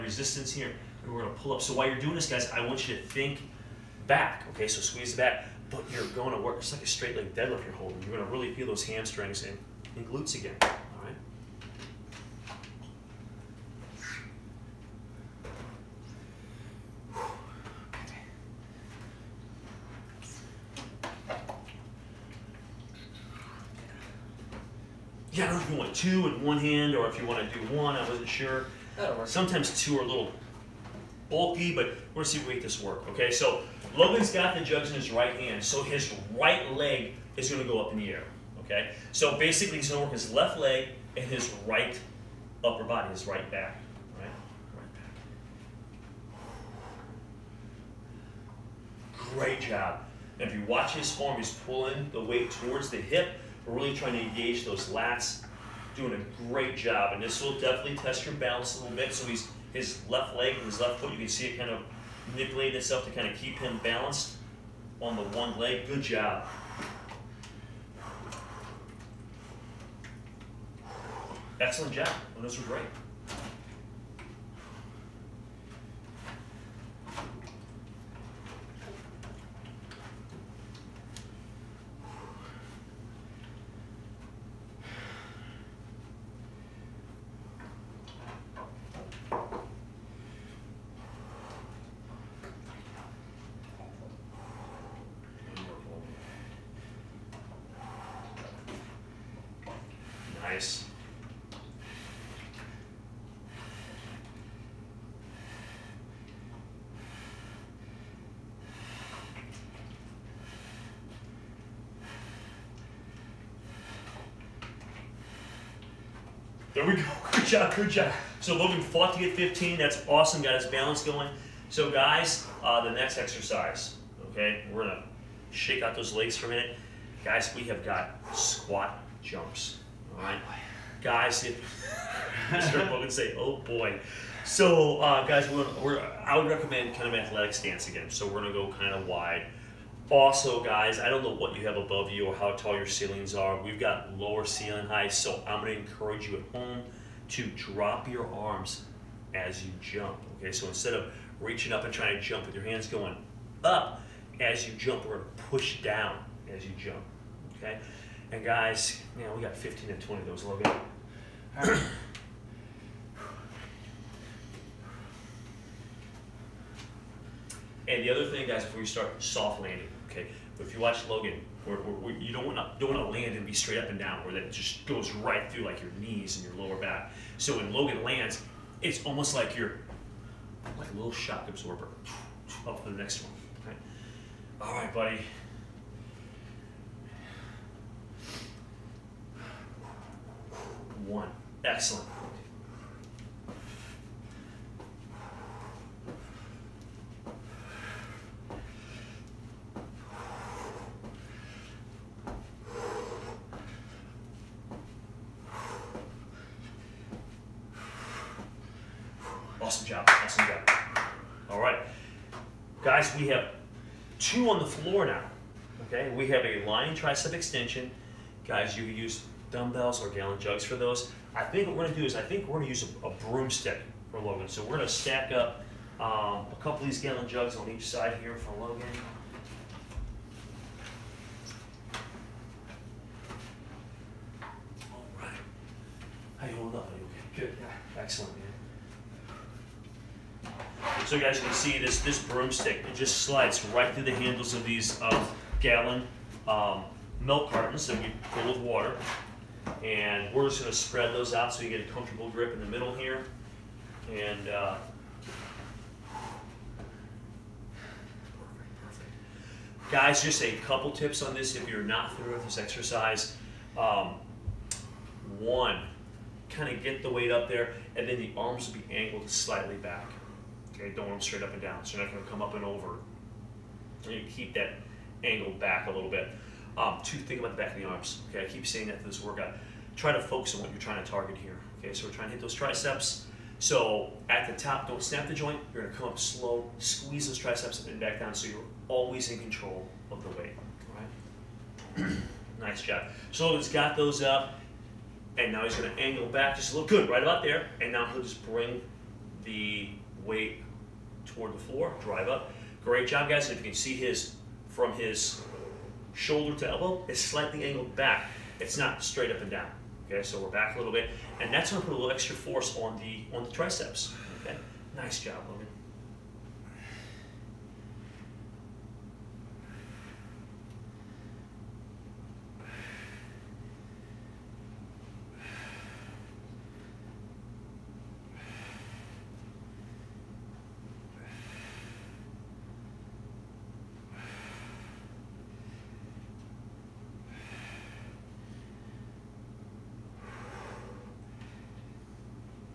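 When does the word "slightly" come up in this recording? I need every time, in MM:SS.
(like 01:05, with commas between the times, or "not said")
04:29, 05:07.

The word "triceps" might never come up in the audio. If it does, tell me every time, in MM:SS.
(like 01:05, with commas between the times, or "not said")
03:36, 04:42, 04:47, 05:13.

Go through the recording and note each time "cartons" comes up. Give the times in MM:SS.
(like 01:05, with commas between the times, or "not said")
04:07.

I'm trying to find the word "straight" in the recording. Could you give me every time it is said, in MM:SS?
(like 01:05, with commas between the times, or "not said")
00:06, 02:53, 04:31, 05:09.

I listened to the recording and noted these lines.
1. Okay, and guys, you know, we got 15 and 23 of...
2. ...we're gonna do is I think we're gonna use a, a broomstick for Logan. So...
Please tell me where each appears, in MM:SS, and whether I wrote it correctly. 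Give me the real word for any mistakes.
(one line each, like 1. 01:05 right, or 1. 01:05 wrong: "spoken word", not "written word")
1. 02:37 wrong: "20", not "23"
2. 03:41 right.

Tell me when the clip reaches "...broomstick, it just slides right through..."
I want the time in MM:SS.
04:02.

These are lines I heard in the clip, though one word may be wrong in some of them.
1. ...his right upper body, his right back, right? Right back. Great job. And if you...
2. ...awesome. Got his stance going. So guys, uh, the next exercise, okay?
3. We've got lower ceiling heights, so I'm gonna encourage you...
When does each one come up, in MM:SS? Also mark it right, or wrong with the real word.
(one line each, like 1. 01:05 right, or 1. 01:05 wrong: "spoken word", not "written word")
1. 00:41 right
2. 02:00 wrong: "balance", not "stance"
3. 02:23 right.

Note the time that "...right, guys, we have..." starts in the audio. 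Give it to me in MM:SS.
03:31.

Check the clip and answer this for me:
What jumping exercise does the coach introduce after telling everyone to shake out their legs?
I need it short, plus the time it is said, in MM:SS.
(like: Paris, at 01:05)
Squat jumps, at 02:08.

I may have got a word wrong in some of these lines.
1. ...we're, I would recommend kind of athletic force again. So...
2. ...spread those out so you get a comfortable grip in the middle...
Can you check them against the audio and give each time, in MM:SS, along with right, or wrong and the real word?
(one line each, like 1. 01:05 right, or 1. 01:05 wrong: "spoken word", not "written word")
1. 02:15 wrong: "stance", not "force"
2. 04:10 right.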